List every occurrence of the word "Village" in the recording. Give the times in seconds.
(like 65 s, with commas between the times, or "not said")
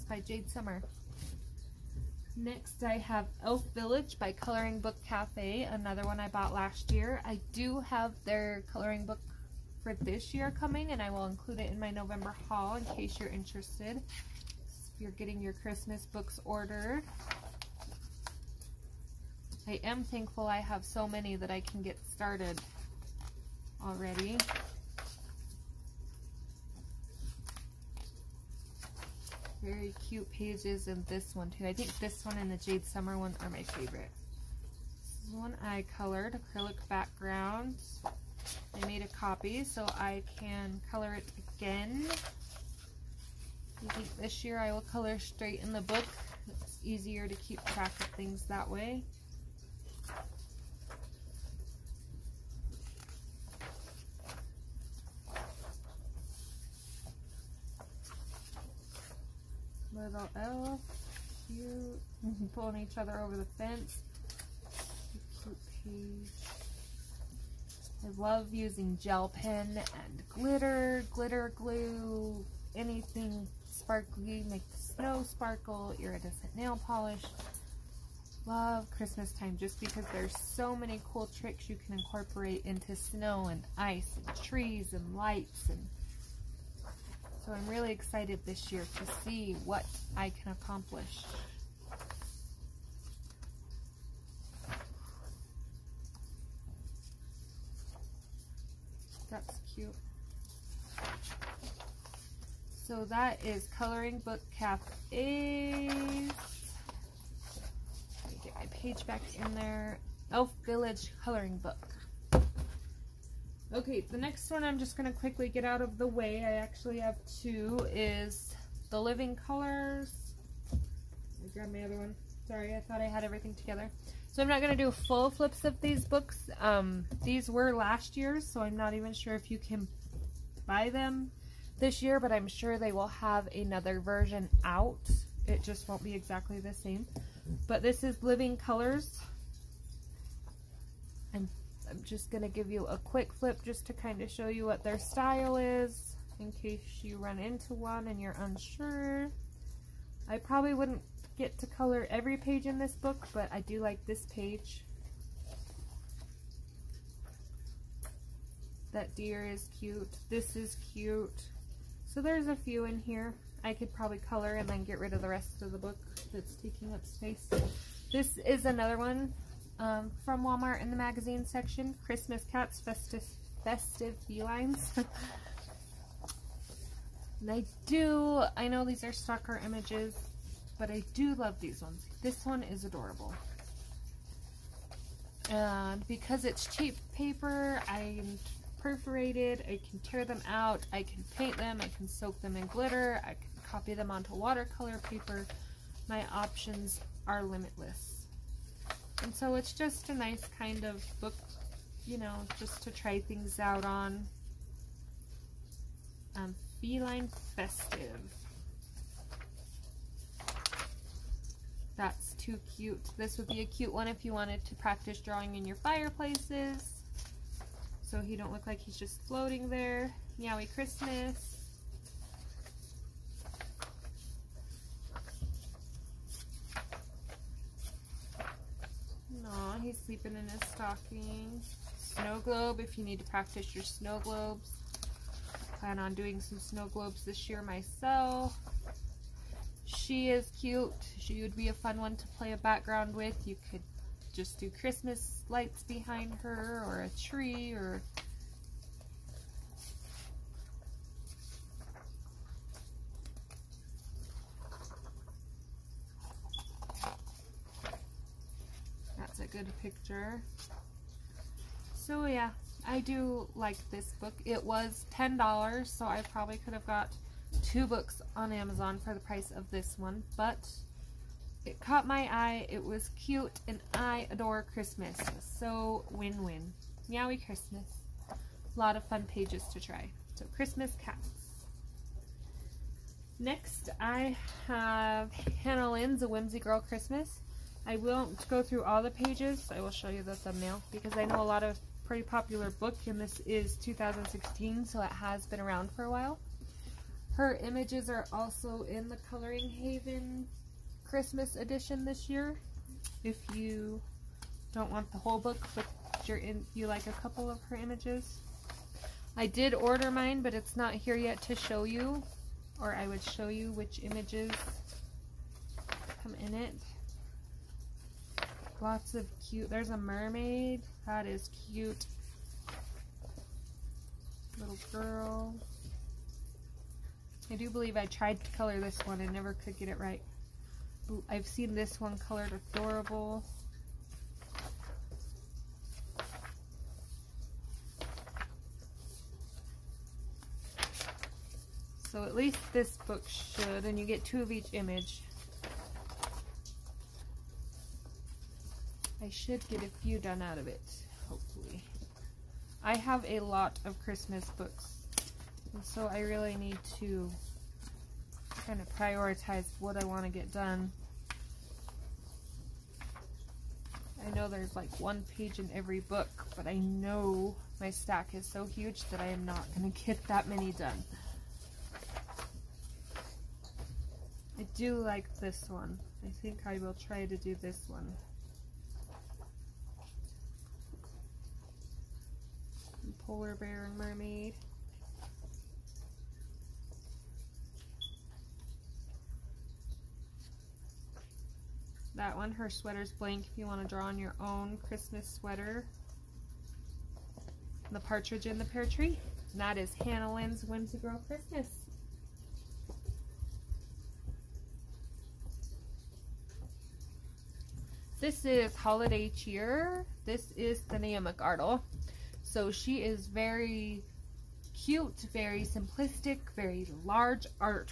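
3 s, 110 s.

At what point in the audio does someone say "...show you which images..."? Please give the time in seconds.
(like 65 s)
313 s.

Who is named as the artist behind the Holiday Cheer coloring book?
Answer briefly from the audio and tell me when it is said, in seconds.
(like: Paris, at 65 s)
Thaneeya McArdle, at 410 s.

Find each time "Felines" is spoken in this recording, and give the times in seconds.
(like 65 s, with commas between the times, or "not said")
174 s, 206 s.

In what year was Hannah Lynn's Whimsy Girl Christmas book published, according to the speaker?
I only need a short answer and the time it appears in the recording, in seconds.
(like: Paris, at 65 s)
2016, at 293 s.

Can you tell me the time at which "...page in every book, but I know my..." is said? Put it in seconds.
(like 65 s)
365 s.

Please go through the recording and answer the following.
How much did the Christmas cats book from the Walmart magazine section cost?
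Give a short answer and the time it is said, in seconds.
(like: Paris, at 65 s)
$10, at 265 s.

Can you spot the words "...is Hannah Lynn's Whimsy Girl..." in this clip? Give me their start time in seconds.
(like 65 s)
399 s.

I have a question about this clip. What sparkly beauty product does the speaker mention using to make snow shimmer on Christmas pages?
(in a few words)
iridescent nail polish.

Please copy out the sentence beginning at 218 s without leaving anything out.
So he don't look like he's just floating there.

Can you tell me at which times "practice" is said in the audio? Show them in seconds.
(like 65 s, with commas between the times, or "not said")
214 s, 233 s.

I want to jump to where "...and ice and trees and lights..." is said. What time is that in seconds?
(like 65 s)
83 s.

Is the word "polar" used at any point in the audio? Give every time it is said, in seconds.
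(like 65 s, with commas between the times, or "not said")
383 s.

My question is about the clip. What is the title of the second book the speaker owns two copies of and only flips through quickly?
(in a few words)
The Living Colors.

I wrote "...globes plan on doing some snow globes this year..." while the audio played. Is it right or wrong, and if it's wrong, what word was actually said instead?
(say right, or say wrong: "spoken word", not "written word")
right.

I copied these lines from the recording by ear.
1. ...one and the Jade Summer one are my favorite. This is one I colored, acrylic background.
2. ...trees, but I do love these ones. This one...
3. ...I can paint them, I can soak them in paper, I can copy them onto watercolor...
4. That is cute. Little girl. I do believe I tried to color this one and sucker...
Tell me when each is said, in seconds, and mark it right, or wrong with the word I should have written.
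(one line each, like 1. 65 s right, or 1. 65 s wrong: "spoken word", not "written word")
1. 32 s right
2. 179 s wrong: "images", not "trees"
3. 190 s wrong: "glitter", not "paper"
4. 321 s wrong: "never", not "sucker".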